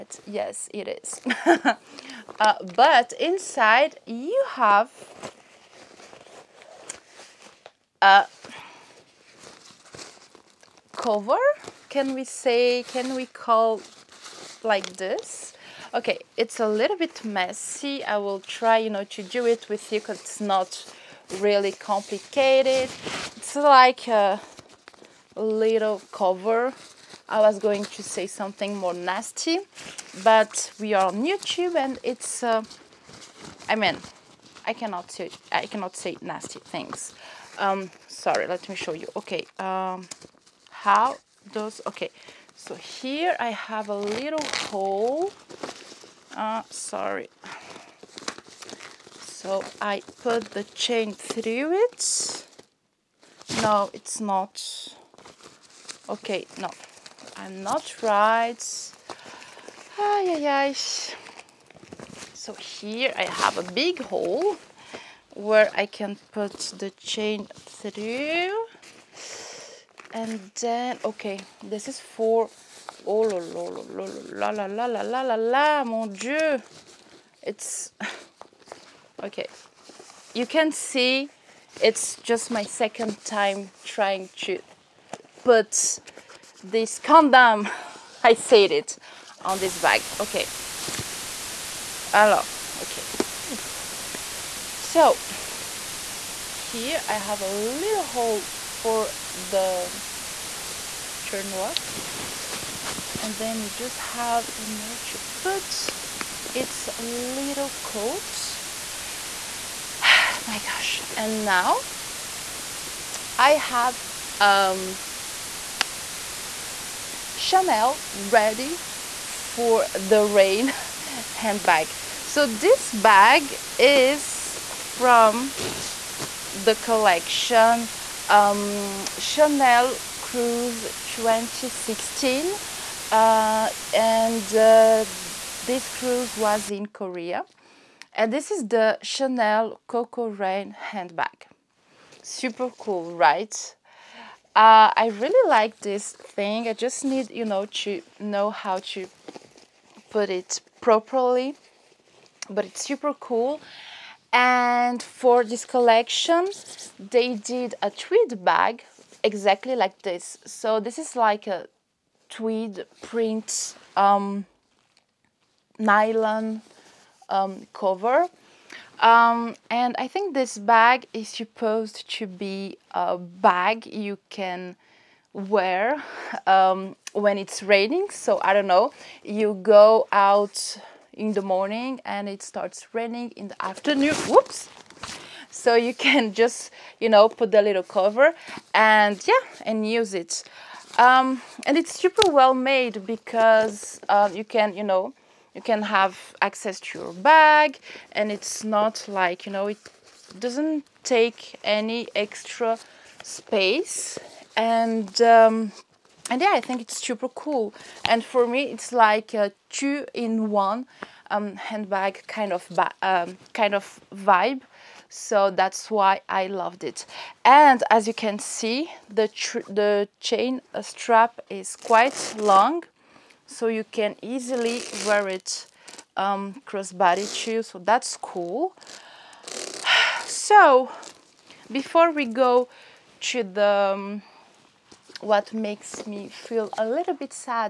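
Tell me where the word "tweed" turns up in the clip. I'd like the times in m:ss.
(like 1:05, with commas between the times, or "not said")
2:37, 2:42.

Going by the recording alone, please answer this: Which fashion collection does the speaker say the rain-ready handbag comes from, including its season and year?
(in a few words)
Chanel Cruise 2016.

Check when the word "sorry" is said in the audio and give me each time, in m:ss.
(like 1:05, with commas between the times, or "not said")
0:38, 0:46.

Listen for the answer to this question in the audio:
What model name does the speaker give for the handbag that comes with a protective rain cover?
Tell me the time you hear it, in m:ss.
2:19.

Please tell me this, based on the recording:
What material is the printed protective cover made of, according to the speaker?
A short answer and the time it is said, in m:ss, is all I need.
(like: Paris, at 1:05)
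nylon, at 2:45.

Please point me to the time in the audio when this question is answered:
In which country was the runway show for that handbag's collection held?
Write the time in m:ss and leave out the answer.
2:16.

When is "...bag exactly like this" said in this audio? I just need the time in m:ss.
2:38.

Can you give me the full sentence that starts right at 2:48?
Um, and I think this bag is supposed to be a bag you can wear um, when it's raining.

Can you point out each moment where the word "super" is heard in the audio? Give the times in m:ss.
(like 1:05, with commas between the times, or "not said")
2:22, 2:32, 3:11, 3:27.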